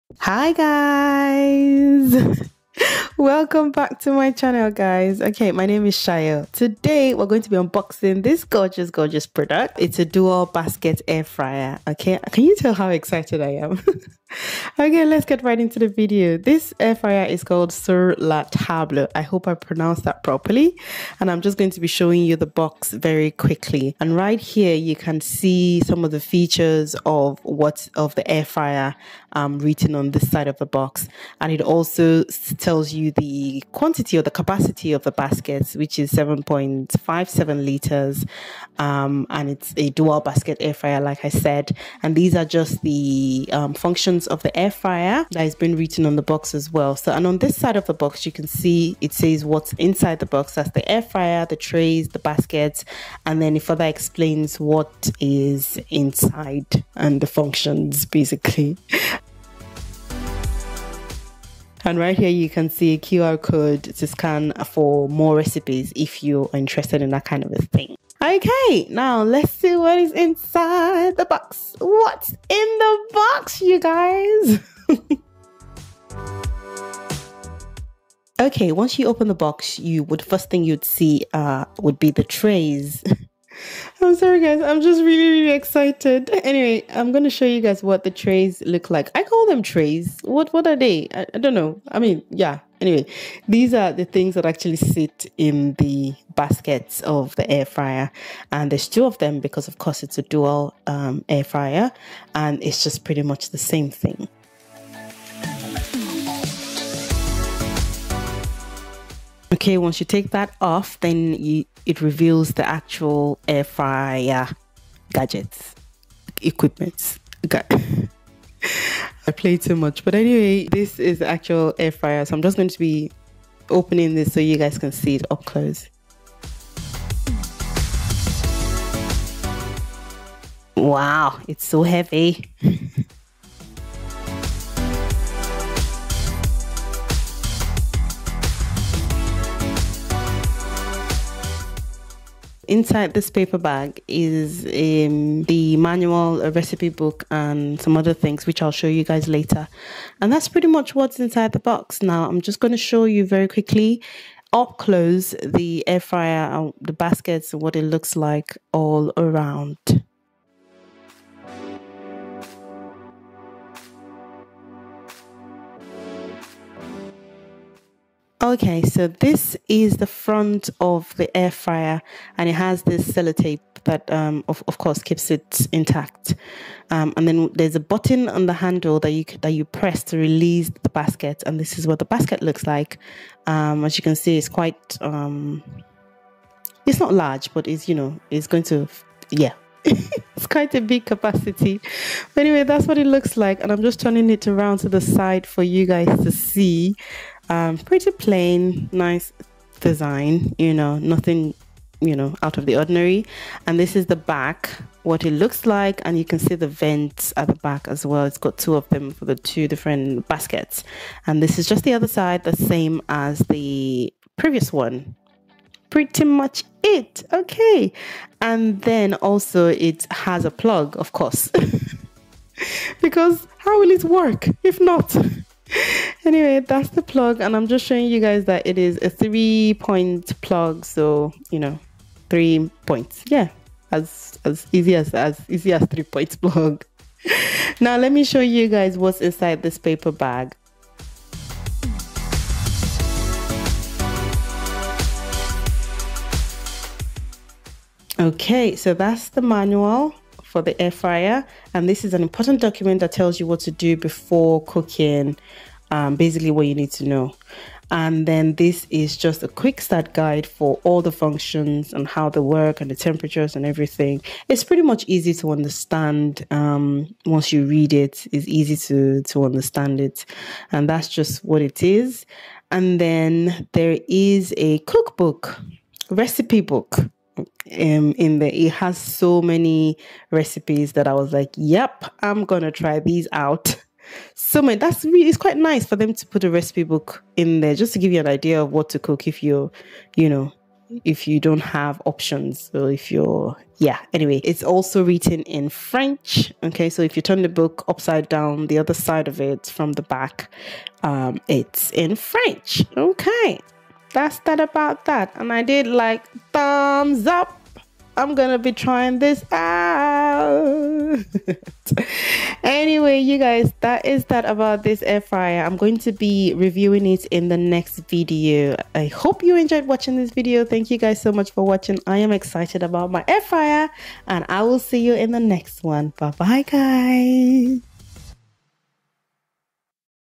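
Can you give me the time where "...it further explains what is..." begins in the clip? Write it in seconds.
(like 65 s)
53 s.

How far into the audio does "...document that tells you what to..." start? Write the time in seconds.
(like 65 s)
252 s.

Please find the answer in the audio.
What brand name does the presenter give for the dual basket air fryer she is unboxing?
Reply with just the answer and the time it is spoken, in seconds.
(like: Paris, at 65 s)
Sur La Table, at 17 s.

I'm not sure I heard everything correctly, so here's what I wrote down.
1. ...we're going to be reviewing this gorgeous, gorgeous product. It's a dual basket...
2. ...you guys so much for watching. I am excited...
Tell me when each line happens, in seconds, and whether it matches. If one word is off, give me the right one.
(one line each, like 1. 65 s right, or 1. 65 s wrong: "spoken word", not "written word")
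1. 7 s wrong: "unboxing", not "reviewing"
2. 320 s right.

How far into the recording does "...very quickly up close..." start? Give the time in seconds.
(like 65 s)
153 s.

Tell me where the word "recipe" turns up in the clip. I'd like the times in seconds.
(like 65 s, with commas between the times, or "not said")
65 s, 146 s, 276 s, 280 s, 286 s.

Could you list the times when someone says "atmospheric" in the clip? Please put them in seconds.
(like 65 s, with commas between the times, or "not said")
not said.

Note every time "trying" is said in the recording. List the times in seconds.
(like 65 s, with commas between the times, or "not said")
308 s.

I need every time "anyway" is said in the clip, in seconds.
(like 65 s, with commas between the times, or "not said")
86 s, 92 s, 120 s, 192 s, 226 s, 294 s, 312 s.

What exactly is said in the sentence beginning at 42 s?
And these are just the um, functions of the air fryer that has been written on the box as well.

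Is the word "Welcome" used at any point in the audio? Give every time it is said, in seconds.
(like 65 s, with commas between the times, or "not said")
3 s.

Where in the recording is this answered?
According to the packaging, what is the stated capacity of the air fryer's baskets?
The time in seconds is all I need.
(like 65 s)
36 s.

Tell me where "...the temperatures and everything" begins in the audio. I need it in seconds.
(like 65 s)
262 s.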